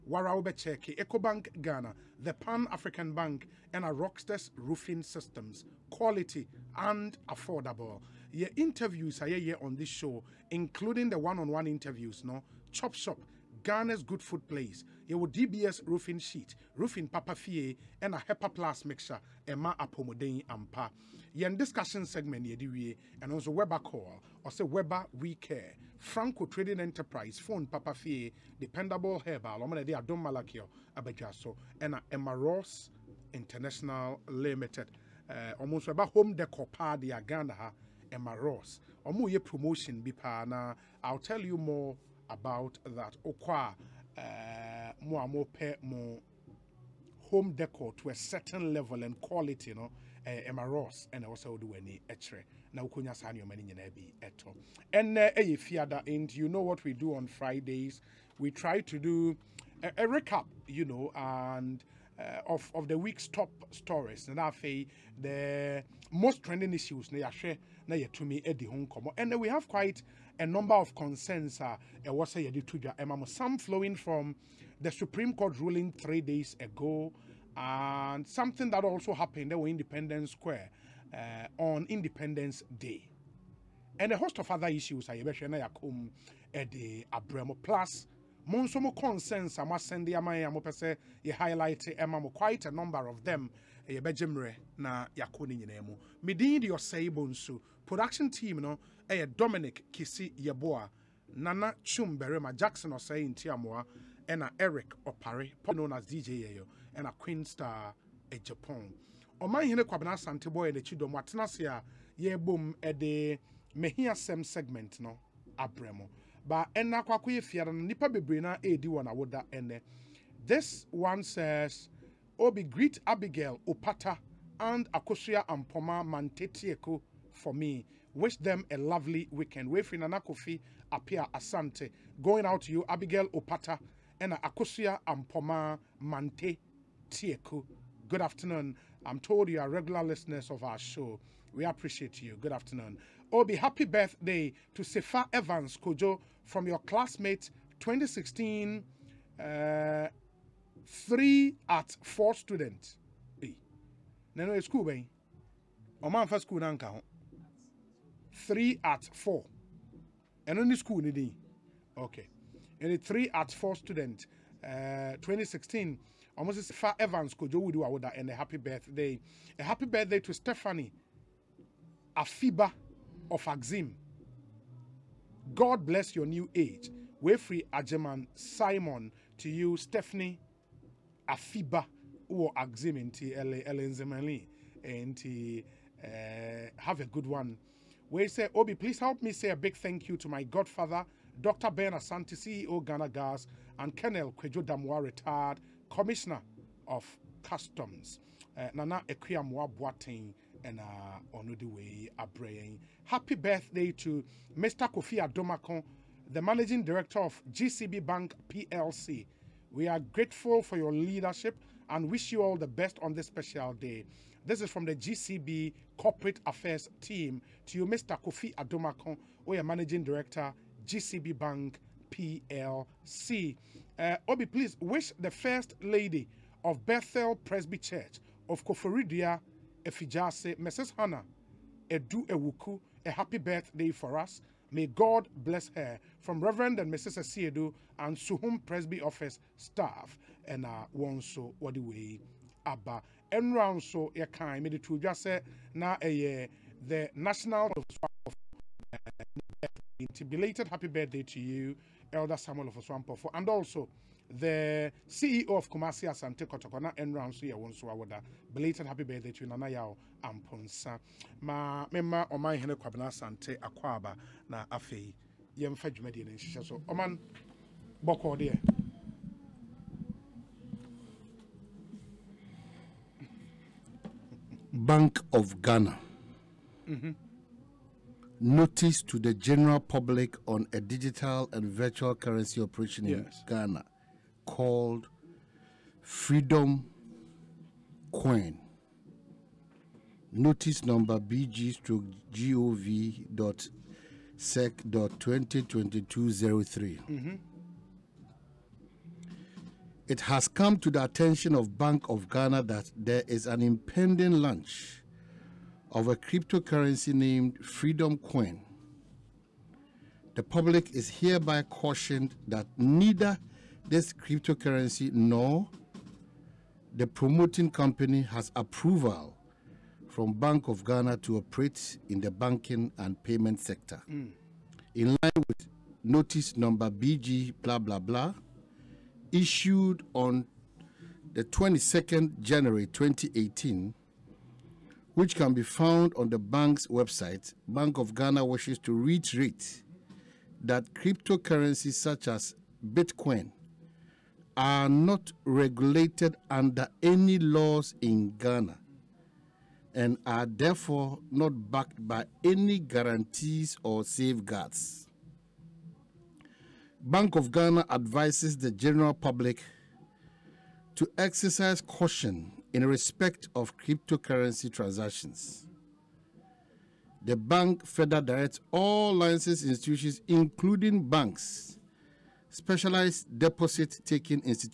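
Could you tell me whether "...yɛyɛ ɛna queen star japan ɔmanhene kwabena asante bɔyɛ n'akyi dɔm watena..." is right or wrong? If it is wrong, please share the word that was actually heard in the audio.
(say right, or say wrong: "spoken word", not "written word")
right.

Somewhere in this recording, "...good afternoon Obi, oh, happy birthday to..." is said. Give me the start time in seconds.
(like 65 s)
142 s.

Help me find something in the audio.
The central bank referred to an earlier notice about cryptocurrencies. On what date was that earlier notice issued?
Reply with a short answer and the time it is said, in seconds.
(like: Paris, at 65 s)
22nd January 2018, at 331 s.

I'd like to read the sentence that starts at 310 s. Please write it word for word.
The public is hereby cautioned that neither this cryptocurrency?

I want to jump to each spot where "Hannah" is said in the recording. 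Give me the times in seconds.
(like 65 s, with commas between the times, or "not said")
230 s.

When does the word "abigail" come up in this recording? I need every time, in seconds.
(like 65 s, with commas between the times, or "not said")
123 s, 132 s.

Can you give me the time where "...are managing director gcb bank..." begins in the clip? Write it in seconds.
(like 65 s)
219 s.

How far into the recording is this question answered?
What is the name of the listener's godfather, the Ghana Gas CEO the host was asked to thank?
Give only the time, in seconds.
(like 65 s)
191 s.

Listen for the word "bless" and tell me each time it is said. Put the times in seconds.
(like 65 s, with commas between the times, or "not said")
175 s, 235 s.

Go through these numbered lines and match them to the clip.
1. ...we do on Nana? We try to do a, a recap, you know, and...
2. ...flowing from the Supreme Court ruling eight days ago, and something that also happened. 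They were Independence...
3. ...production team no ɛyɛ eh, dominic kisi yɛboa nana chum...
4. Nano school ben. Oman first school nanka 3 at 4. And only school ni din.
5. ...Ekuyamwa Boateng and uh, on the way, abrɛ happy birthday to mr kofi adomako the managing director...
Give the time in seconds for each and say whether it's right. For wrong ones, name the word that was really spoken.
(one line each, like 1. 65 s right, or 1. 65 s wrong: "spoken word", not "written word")
1. 56 s wrong: "Fridays", not "Nana"
2. 73 s wrong: "three", not "eight"
3. 97 s right
4. 154 s right
5. 199 s right.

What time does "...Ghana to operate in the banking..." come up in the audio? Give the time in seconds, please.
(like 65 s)
320 s.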